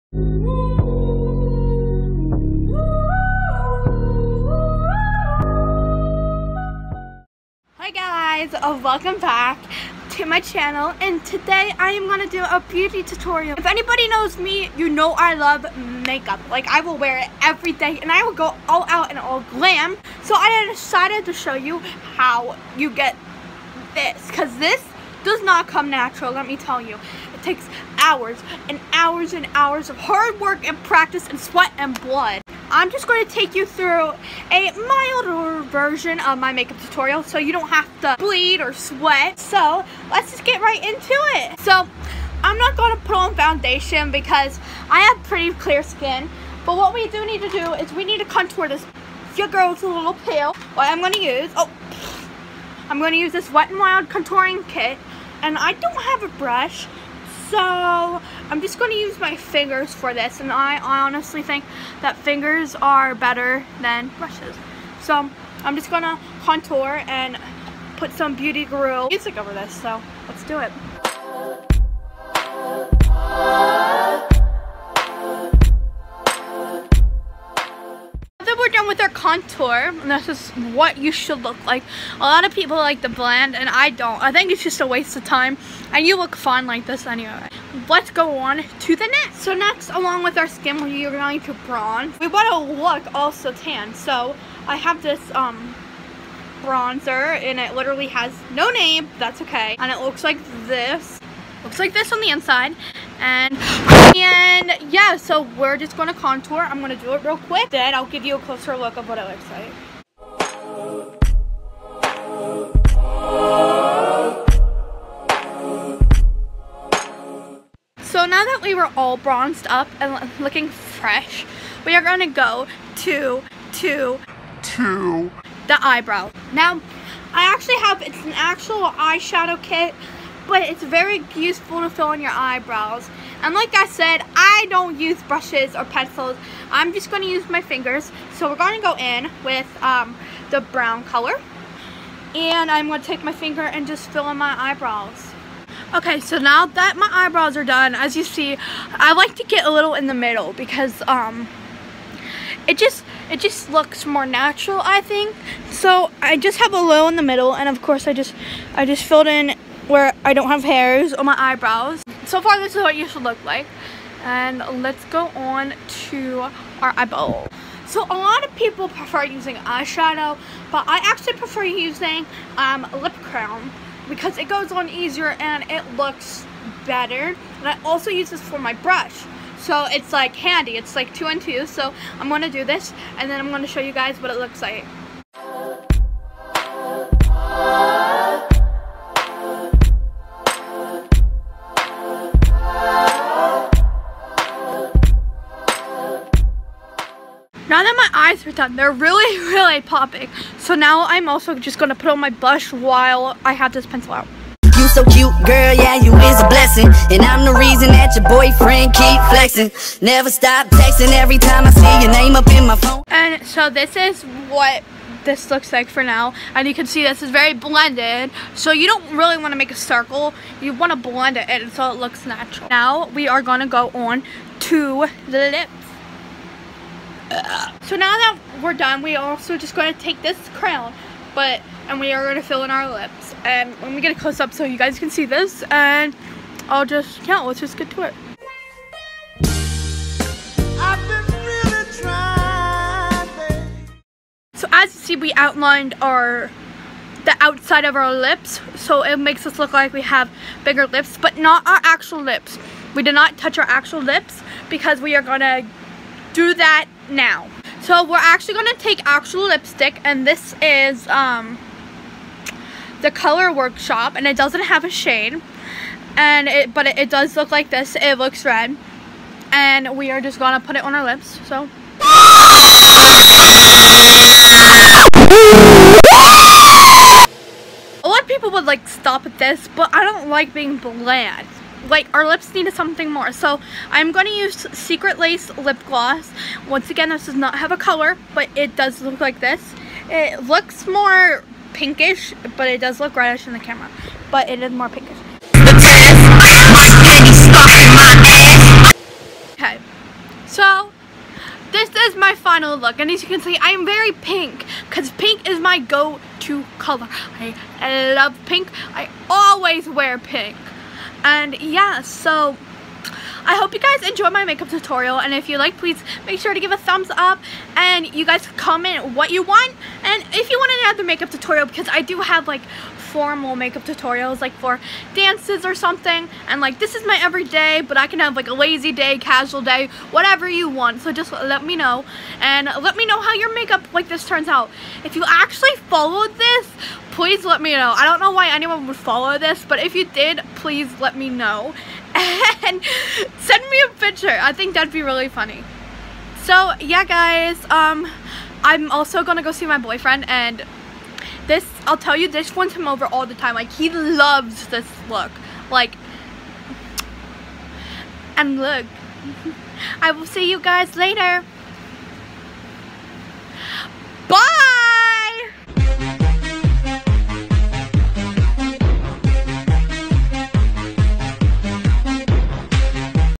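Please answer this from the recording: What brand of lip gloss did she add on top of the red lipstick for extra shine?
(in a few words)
Secret Lace.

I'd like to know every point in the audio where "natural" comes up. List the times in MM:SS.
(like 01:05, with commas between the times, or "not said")
00:25, 02:34, 03:42.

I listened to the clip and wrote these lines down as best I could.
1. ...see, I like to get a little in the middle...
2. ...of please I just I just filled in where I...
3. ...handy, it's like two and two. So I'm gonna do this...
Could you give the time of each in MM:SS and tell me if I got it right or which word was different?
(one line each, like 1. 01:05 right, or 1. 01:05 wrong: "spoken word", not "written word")
1. 02:28 right
2. 02:37 wrong: "course", not "please"
3. 03:00 right.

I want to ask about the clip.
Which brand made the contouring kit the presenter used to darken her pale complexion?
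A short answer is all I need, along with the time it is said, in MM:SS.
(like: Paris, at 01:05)
Wet n Wild, at 00:53.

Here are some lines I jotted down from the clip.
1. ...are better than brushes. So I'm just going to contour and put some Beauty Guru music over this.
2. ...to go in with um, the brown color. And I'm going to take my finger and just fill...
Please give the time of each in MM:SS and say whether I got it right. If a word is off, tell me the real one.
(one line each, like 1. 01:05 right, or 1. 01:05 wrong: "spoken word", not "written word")
1. 01:02 right
2. 02:18 right.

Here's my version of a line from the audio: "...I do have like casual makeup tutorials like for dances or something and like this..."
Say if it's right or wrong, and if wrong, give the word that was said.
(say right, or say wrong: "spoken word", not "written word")
wrong: "formal", not "casual".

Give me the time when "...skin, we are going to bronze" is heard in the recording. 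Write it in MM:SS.
01:30.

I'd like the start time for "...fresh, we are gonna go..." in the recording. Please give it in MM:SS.
02:00.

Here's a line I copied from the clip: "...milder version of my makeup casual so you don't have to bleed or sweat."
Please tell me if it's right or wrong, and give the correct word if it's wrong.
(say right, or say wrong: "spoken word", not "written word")
wrong: "tutorial", not "casual".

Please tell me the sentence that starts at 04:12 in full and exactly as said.
We did not touch our actual lips because we are gonna do that now.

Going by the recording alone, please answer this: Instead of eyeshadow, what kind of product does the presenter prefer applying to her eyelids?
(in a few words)
Lip cream.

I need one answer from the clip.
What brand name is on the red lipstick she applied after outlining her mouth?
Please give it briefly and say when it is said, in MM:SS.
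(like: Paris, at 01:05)
Color Workshop, at 04:23.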